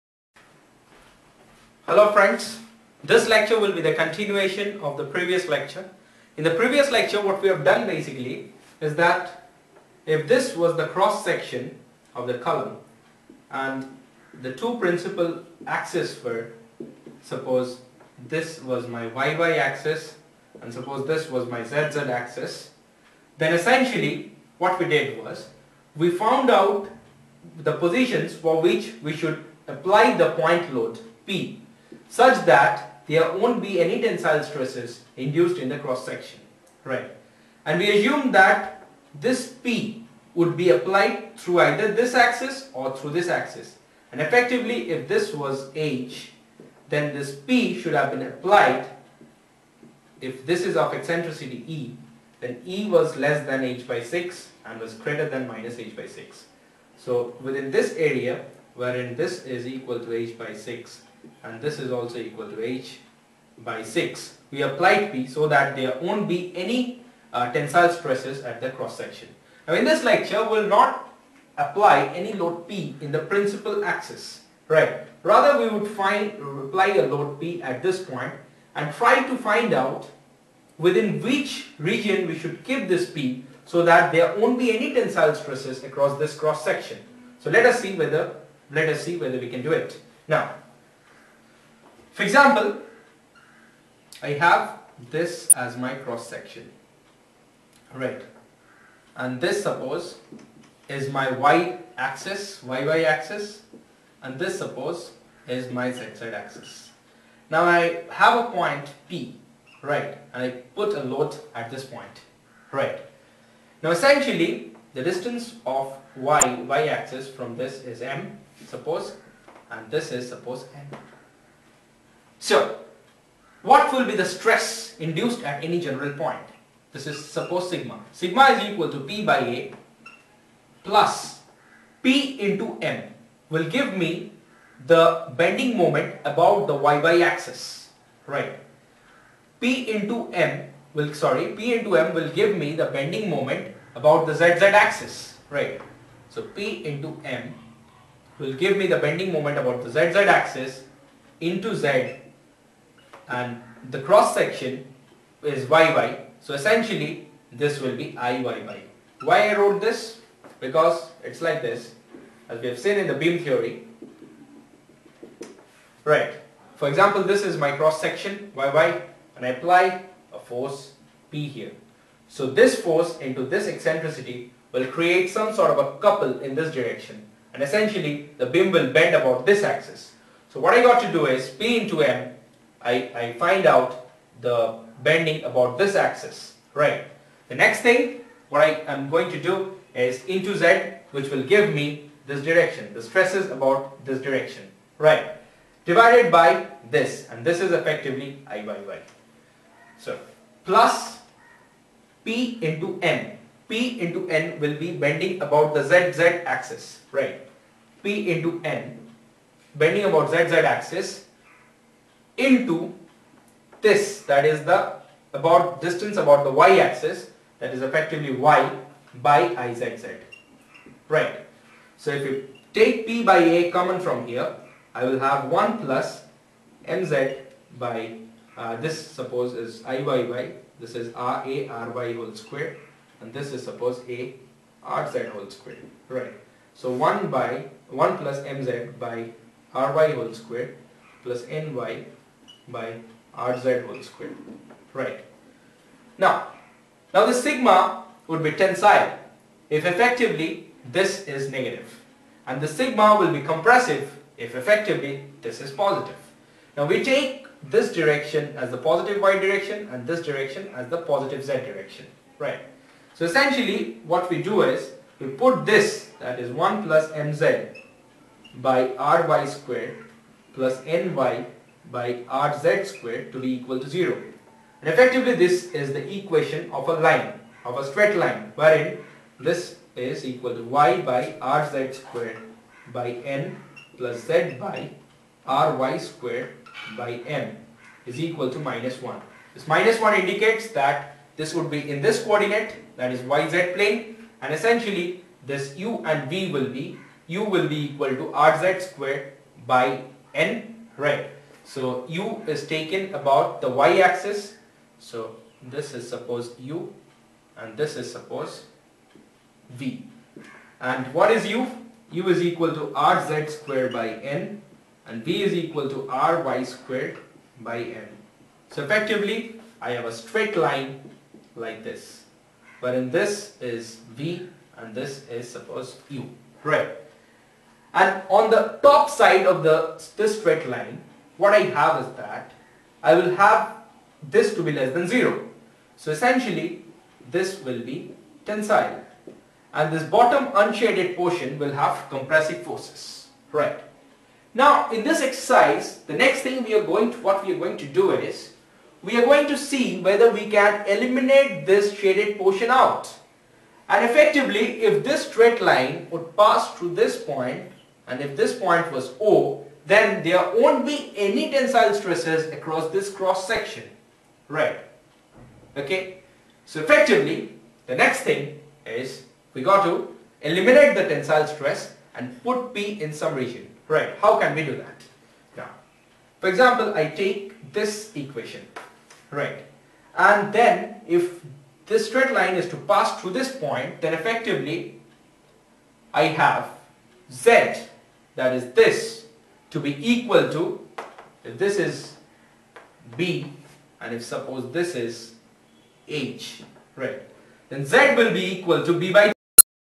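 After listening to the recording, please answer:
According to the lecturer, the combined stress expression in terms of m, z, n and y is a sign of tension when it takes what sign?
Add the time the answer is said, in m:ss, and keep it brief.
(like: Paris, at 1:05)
negative, at 4:11.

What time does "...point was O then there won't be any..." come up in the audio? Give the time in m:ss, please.
5:58.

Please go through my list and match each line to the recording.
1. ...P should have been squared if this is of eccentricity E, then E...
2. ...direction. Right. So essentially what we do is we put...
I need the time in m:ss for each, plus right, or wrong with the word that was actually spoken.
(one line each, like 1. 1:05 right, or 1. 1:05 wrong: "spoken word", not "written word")
1. 0:47 wrong: "applied", not "squared"
2. 4:21 right.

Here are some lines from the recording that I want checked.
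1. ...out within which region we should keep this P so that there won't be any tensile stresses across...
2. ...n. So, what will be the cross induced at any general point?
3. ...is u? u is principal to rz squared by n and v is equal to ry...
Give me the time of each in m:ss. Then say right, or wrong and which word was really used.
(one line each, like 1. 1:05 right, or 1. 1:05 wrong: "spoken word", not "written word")
1. 1:19 right
2. 2:00 wrong: "stress", not "cross"
3. 5:11 wrong: "equal", not "principal".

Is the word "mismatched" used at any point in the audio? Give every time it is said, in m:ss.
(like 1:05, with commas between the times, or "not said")
not said.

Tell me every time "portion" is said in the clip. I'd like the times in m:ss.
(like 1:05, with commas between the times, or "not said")
5:41, 5:52.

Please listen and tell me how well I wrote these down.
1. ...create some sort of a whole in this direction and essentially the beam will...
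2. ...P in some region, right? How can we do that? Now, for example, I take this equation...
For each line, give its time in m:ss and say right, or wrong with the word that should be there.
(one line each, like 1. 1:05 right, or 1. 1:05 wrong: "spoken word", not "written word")
1. 2:54 wrong: "couple", not "whole"
2. 6:12 right.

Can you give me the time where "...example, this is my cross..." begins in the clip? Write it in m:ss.
2:46.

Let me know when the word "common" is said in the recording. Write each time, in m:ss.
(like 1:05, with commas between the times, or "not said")
3:43.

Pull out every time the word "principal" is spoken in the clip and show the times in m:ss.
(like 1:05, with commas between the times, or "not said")
0:14, 1:13.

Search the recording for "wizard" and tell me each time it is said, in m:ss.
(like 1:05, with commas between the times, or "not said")
not said.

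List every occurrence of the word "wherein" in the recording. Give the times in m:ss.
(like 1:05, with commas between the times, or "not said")
0:58, 4:38, 5:22.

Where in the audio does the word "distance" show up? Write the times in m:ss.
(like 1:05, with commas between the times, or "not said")
1:55, 3:35.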